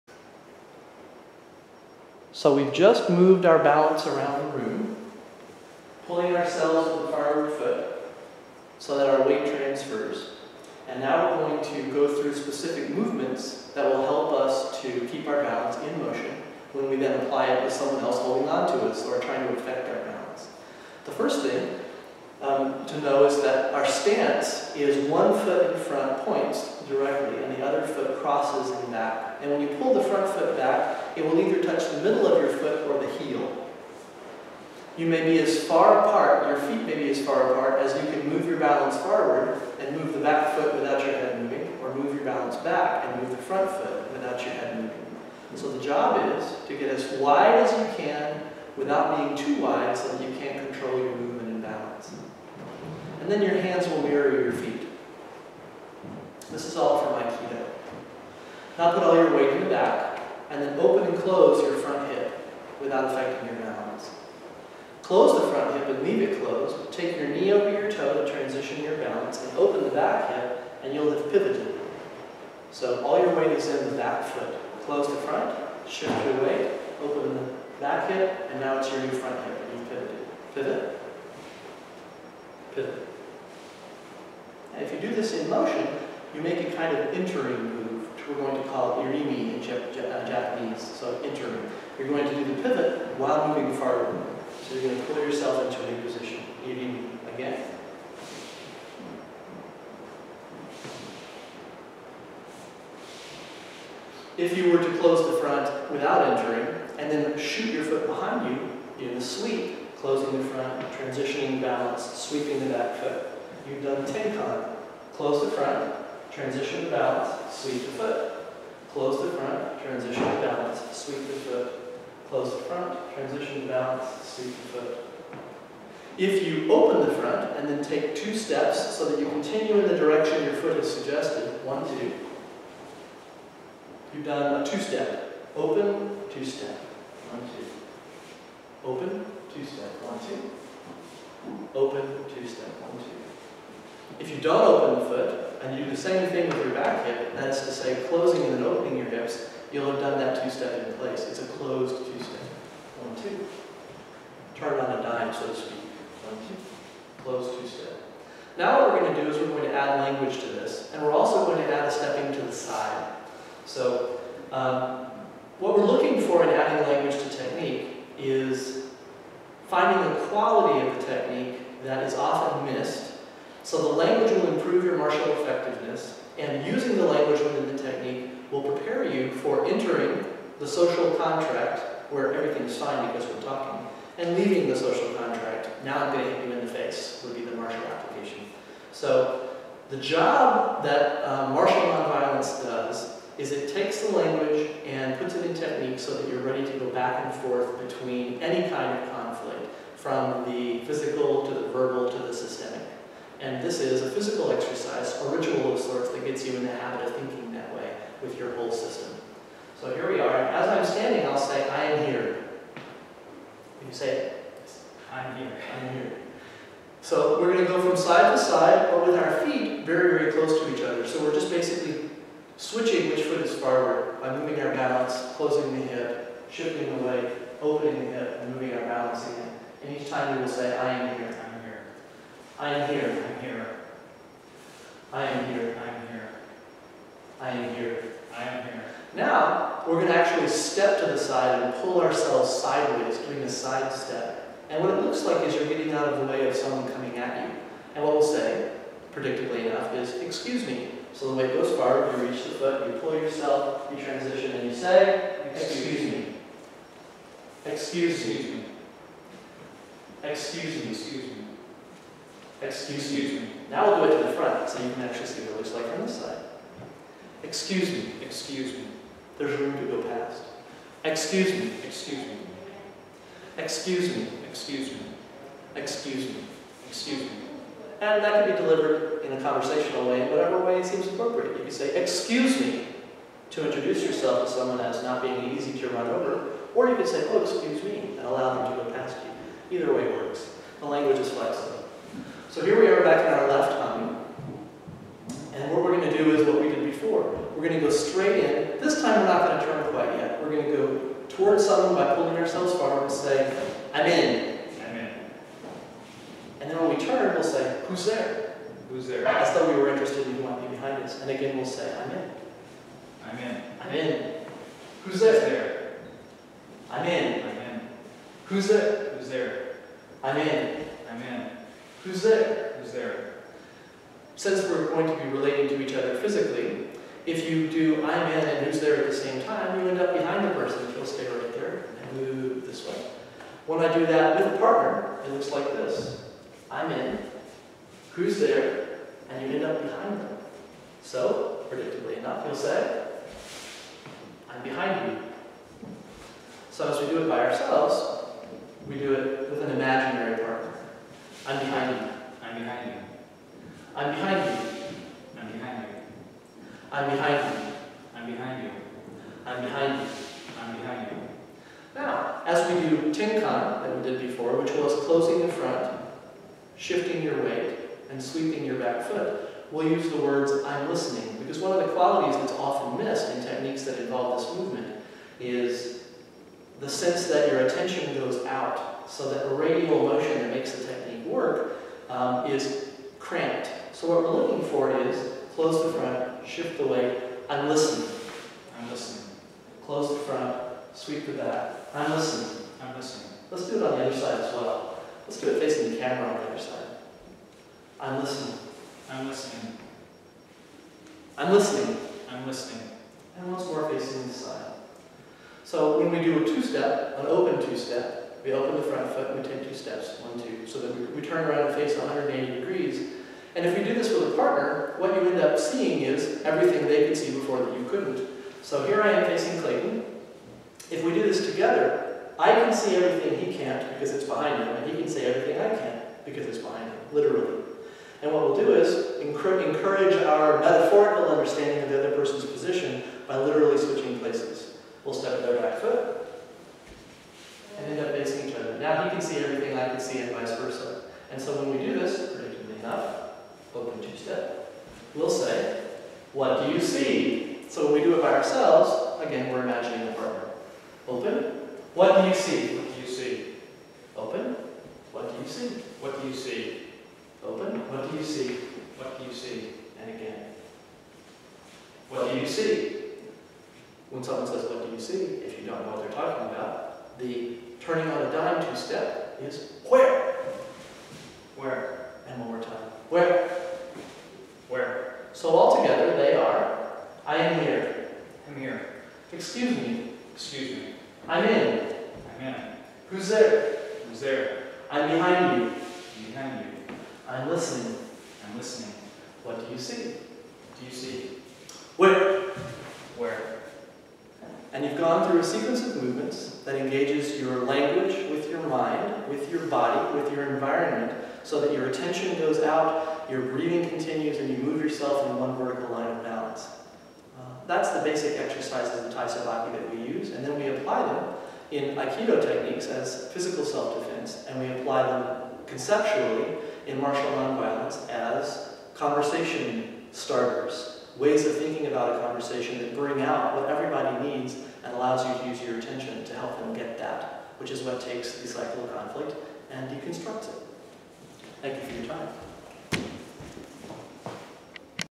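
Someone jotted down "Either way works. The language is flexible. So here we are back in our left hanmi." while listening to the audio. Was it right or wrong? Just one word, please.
right.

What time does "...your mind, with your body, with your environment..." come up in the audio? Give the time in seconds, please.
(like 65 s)
498 s.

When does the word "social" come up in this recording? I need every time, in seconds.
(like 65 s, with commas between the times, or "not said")
180 s, 184 s.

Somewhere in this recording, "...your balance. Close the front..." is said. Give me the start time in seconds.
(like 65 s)
63 s.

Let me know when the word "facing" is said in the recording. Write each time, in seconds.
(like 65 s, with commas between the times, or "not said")
395 s, 403 s, 419 s, 438 s.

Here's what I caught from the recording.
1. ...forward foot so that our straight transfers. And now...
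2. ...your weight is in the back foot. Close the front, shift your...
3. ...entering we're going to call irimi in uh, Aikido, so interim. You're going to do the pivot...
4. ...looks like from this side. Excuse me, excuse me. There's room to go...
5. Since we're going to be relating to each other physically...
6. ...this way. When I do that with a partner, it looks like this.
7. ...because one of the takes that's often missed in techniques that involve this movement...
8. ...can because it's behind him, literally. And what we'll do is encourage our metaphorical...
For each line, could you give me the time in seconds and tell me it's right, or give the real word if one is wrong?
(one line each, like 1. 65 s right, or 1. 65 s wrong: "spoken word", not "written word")
1. 7 s wrong: "weight", not "straight"
2. 73 s right
3. 87 s wrong: "Japanese", not "Aikido"
4. 265 s right
5. 324 s right
6. 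332 s right
7. 371 s wrong: "qualities", not "takes"
8. 425 s right.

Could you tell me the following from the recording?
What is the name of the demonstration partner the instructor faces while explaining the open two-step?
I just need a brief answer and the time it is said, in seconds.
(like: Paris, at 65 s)
Clayton, at 419 s.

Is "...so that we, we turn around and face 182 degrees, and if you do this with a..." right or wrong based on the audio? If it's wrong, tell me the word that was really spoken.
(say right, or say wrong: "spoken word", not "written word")
wrong: "180", not "182".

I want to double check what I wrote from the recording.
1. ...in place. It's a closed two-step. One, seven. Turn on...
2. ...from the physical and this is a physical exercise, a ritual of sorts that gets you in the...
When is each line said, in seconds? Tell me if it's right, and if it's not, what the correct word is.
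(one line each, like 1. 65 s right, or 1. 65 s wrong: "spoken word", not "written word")
1. 150 s wrong: "two", not "seven"
2. 199 s right.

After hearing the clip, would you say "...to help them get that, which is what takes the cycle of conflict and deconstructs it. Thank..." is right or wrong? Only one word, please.
right.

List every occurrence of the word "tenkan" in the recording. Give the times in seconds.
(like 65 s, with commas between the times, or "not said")
114 s, 363 s.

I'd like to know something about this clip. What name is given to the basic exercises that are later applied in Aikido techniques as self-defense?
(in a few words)
Taisabaki.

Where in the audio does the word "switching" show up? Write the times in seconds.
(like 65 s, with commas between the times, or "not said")
222 s, 433 s.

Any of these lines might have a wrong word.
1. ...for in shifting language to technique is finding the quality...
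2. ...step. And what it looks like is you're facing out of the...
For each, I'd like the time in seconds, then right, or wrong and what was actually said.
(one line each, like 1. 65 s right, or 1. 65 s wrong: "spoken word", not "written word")
1. 166 s wrong: "adding", not "shifting"
2. 243 s wrong: "getting", not "facing".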